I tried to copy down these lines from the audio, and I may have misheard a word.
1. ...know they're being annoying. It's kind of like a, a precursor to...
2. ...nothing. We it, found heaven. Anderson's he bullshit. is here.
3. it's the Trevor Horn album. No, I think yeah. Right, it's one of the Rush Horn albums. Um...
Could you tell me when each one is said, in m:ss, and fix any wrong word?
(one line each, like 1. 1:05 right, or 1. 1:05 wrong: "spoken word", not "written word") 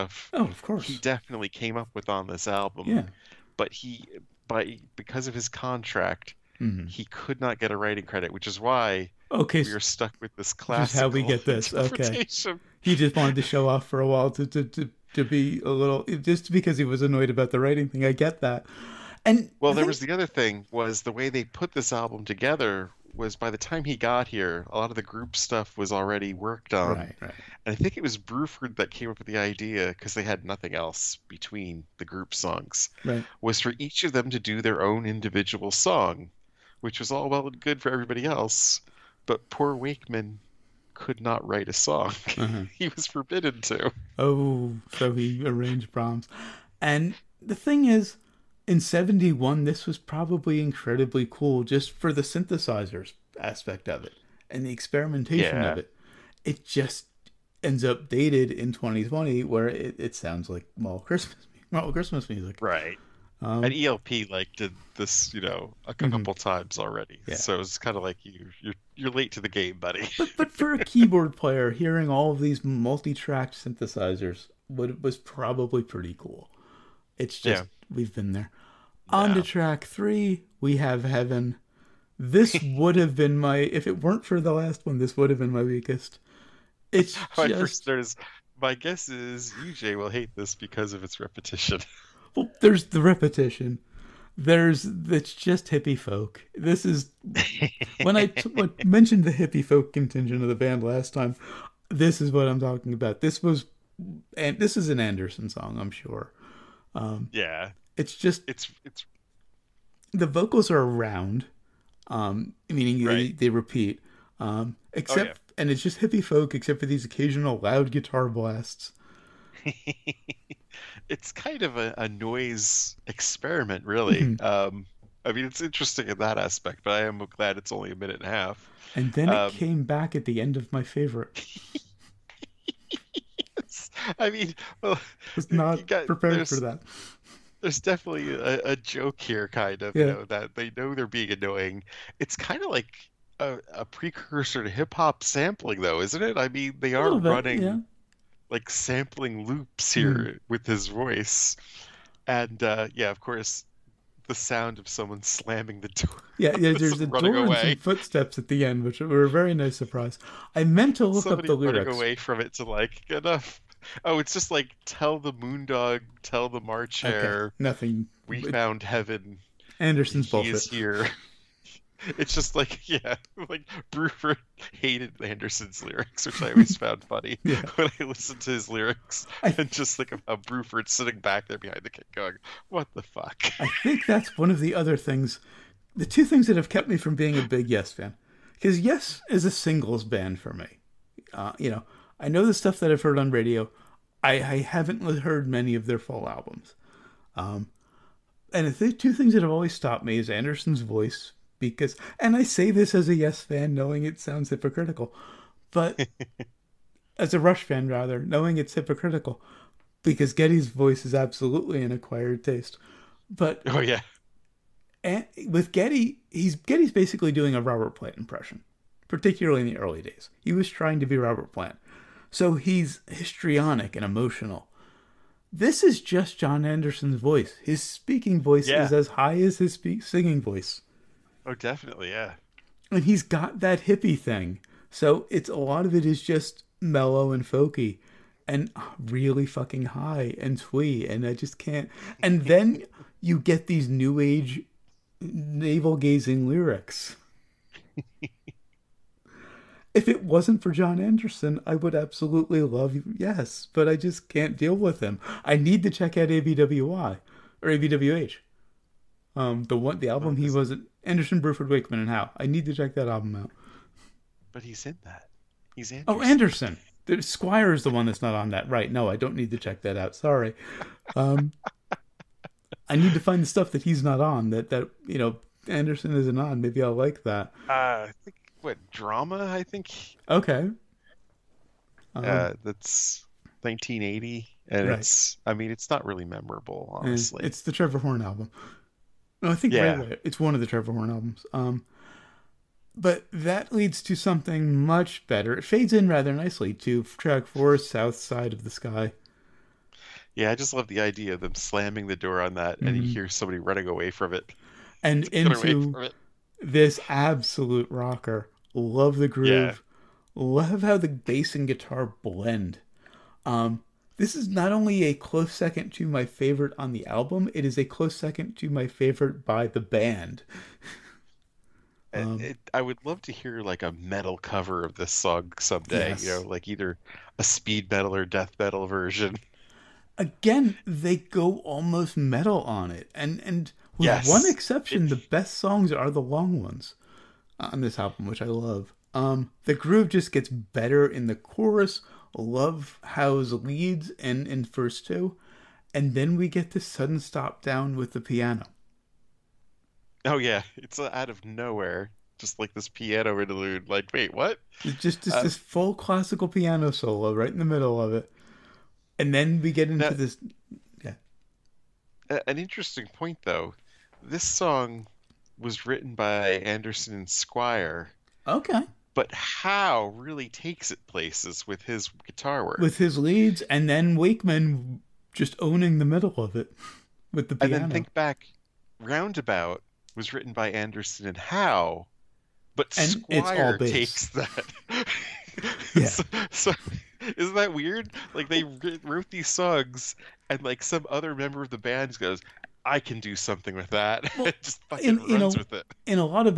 1. 2:20 right
2. 2:47 right
3. 4:47 wrong: "Trevor", not "Rush".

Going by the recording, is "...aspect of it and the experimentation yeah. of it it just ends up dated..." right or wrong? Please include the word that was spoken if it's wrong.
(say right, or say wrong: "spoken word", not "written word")
right.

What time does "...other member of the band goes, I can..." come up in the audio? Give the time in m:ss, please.
6:31.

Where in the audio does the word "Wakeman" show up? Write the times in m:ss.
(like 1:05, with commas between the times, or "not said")
0:39, 4:21, 6:14.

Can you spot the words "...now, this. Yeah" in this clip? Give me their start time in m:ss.
6:00.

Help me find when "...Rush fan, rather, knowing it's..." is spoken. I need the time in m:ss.
3:27.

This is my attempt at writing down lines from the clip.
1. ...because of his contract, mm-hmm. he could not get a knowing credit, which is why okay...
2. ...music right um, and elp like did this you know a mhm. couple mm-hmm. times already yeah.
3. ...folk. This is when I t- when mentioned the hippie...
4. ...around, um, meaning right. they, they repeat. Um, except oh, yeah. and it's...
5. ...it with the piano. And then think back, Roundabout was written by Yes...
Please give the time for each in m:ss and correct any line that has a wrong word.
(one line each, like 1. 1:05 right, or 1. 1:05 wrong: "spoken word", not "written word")
1. 0:04 wrong: "writing", not "knowing"
2. 1:02 right
3. 1:35 right
4. 1:50 right
5. 6:16 wrong: "Anderson", not "Yes".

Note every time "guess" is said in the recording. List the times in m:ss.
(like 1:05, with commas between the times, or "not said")
1:28.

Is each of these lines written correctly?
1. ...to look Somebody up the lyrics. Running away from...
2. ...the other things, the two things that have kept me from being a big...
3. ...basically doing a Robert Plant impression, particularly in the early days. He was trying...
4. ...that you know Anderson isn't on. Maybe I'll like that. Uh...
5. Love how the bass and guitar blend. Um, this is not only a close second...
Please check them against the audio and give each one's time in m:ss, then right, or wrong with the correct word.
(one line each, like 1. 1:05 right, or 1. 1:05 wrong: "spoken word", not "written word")
1. 2:40 right
2. 3:04 right
3. 3:36 right
4. 4:34 right
5. 5:10 right.